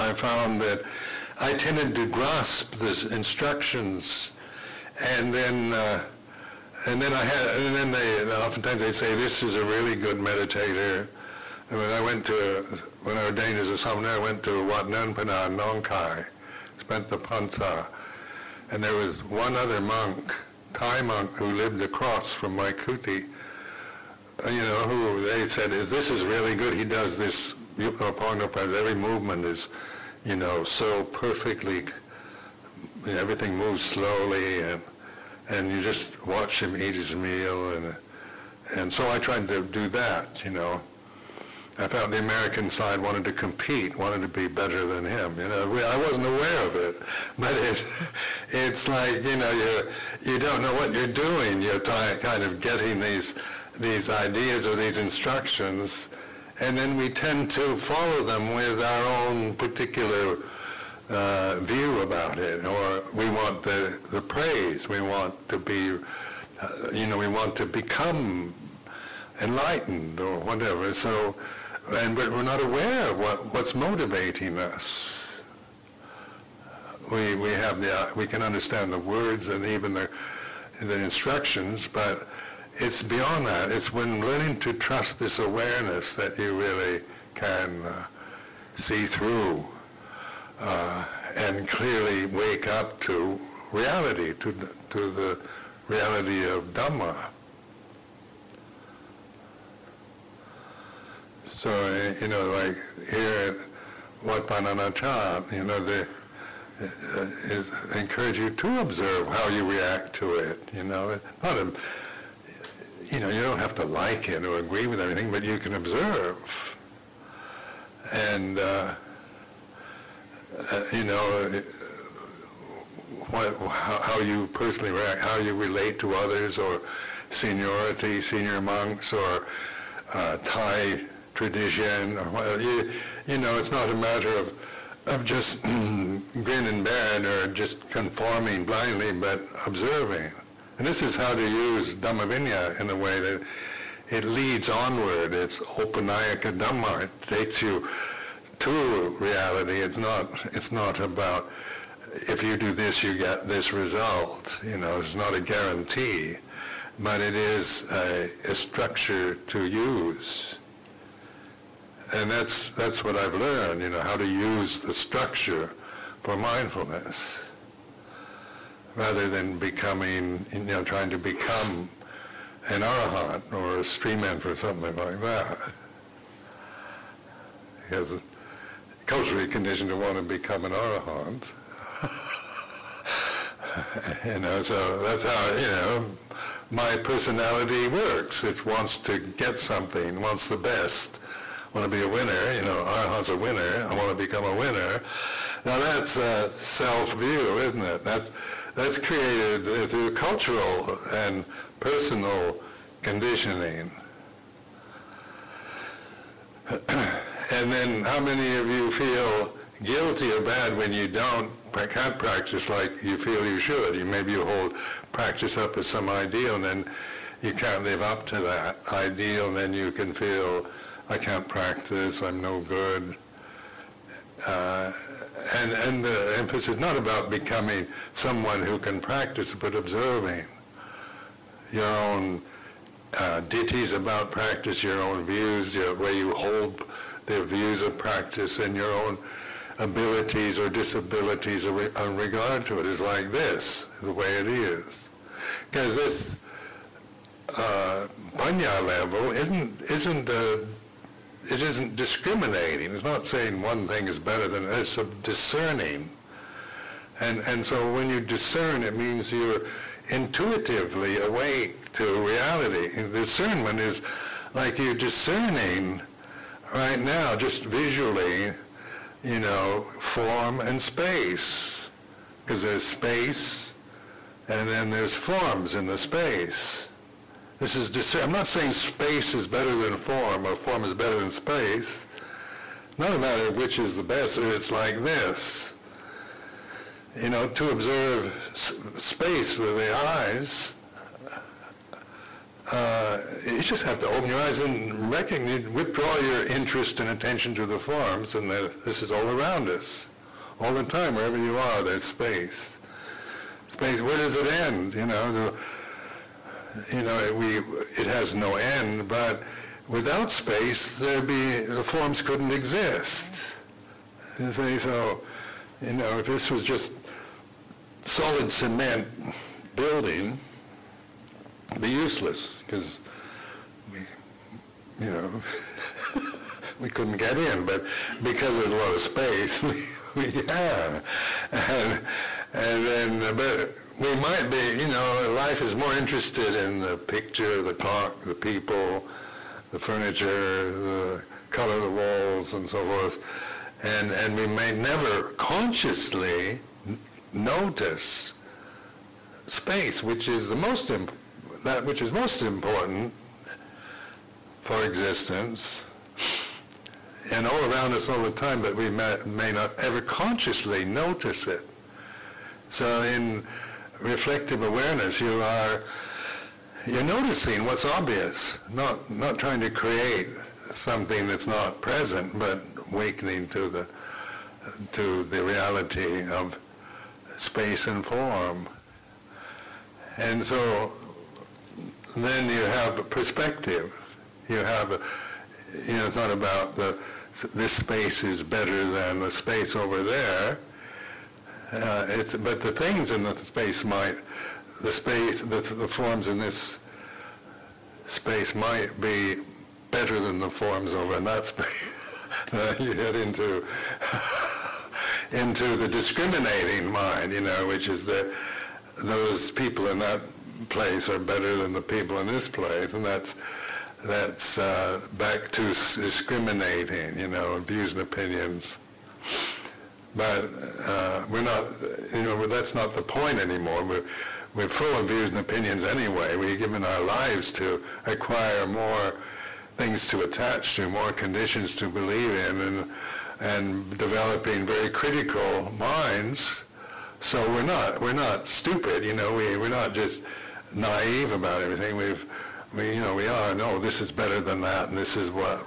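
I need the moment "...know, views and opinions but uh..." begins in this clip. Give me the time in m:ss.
6:57.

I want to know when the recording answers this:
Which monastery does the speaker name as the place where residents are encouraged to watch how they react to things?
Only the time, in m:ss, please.
1:44.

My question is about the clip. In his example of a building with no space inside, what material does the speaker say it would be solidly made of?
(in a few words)
cement.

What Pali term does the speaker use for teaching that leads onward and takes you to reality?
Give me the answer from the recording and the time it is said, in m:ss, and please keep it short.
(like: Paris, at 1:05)
Opanayaka Dhamma, at 2:25.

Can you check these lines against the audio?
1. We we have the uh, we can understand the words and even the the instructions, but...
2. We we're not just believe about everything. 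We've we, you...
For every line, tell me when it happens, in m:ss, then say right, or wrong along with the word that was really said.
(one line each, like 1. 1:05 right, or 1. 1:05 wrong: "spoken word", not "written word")
1. 1:17 right
2. 7:19 wrong: "naive", not "believe".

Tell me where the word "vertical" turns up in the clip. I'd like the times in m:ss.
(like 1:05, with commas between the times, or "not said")
not said.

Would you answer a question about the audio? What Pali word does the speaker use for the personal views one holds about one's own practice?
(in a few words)
diṭṭhis.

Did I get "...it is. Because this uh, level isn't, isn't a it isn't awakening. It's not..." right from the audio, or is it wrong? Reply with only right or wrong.
wrong.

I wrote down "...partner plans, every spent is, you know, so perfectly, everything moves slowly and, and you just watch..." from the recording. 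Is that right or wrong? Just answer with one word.
wrong.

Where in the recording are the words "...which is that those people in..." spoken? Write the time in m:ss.
6:47.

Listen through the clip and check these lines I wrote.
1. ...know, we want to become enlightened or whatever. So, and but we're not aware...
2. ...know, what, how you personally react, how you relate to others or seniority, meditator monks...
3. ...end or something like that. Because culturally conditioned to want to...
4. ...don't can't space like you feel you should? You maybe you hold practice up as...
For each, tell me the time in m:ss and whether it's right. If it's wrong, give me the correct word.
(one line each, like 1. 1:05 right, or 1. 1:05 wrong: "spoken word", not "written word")
1. 1:07 right
2. 2:01 wrong: "senior", not "meditator"
3. 2:54 right
4. 3:31 wrong: "practice", not "space".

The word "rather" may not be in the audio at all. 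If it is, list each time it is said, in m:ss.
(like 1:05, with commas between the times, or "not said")
2:48.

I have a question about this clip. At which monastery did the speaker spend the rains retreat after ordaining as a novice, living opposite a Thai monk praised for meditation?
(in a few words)
Wat Nun Phana Nongkai.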